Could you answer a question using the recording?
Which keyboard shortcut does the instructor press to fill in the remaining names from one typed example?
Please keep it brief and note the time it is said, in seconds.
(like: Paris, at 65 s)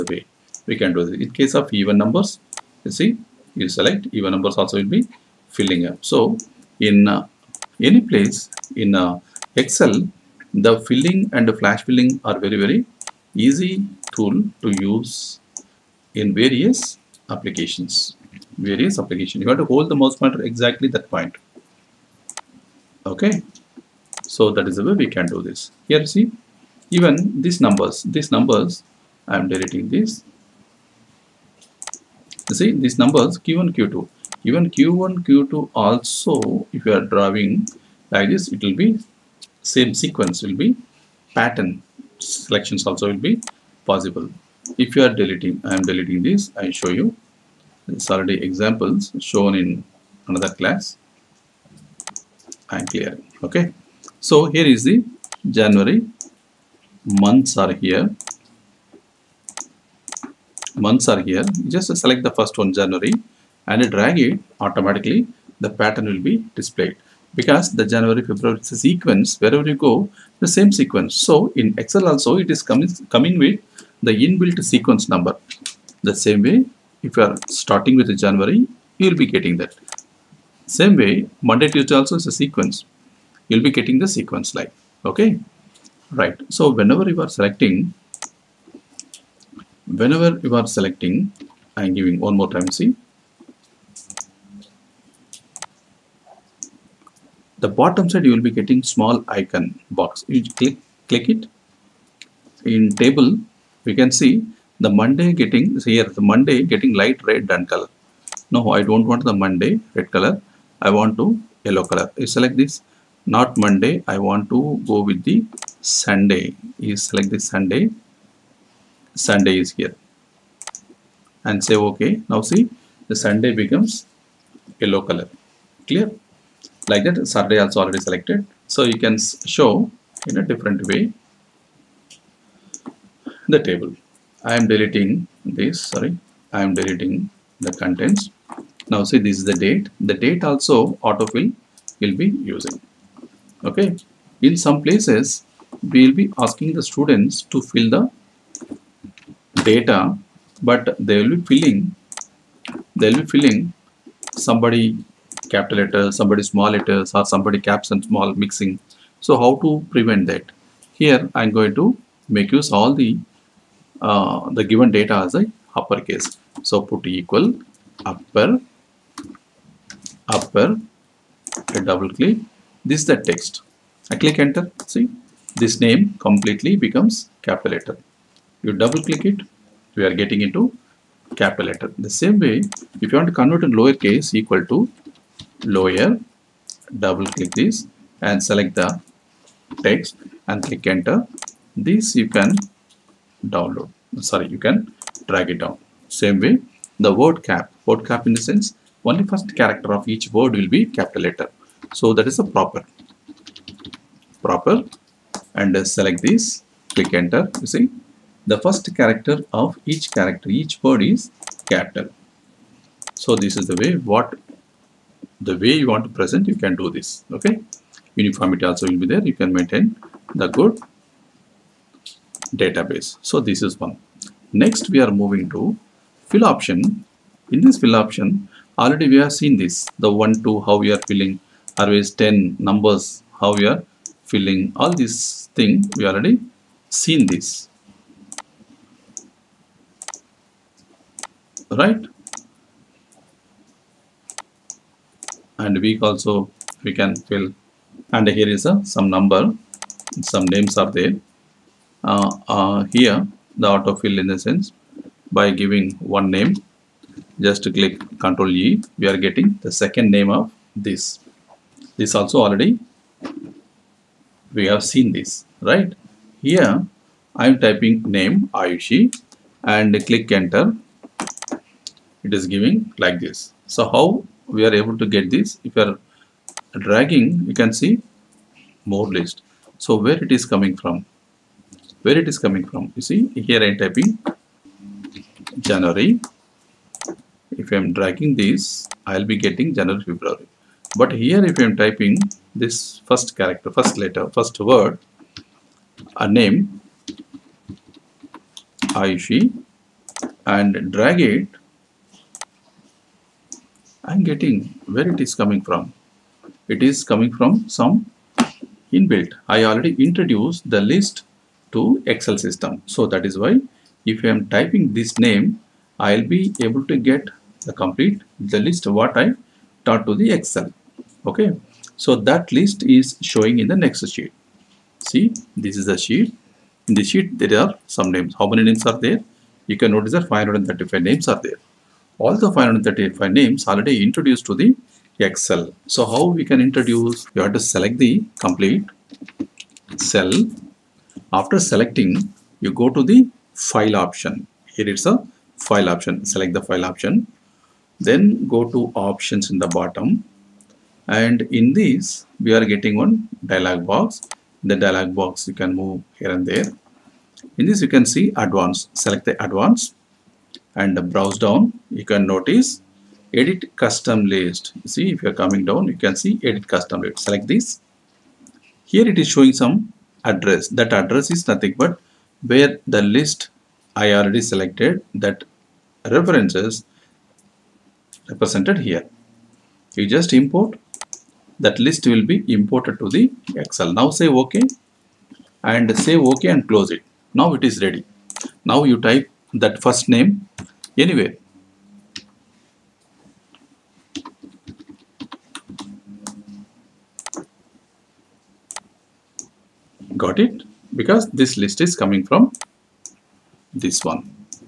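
Control E, at 258 s.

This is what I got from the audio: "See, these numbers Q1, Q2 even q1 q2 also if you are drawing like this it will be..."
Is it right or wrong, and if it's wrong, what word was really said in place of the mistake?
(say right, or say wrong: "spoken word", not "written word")
right.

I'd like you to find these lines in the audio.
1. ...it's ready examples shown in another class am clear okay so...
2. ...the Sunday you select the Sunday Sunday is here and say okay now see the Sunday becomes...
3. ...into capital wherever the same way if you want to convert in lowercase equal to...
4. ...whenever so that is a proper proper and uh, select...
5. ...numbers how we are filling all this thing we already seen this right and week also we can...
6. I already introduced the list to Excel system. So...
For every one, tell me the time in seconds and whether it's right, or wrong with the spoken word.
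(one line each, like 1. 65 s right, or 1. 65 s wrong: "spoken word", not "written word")
1. 47 s wrong: "already", not "ready"
2. 115 s right
3. 180 s wrong: "letter", not "wherever"
4. 201 s wrong: "letter", not "whenever"
5. 232 s right
6. 309 s right.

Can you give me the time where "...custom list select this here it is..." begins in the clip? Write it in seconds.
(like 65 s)
366 s.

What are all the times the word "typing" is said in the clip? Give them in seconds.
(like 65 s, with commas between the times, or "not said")
267 s, 283 s, 291 s, 314 s.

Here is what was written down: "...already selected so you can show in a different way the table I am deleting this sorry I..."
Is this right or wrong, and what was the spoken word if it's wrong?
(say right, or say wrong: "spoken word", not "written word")
right.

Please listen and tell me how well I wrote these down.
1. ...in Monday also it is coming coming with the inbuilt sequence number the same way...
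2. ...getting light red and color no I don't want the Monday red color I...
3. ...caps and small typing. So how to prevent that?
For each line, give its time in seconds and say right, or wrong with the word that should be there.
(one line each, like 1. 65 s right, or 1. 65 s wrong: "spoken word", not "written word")
1. 71 s wrong: "Excel", not "Monday"
2. 106 s right
3. 157 s wrong: "mixing", not "typing".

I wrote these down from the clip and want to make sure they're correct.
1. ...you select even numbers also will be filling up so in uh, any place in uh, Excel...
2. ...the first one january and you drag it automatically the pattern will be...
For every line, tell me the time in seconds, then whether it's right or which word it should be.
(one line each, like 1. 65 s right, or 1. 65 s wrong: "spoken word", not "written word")
1. 3 s right
2. 62 s right.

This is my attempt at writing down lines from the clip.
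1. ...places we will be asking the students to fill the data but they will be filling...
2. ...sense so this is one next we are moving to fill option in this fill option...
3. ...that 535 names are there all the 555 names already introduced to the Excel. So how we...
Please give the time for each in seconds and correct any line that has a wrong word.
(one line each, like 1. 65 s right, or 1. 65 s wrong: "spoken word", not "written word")
1. 144 s right
2. 222 s wrong: "database", not "sense"
3. 330 s wrong: "535", not "555".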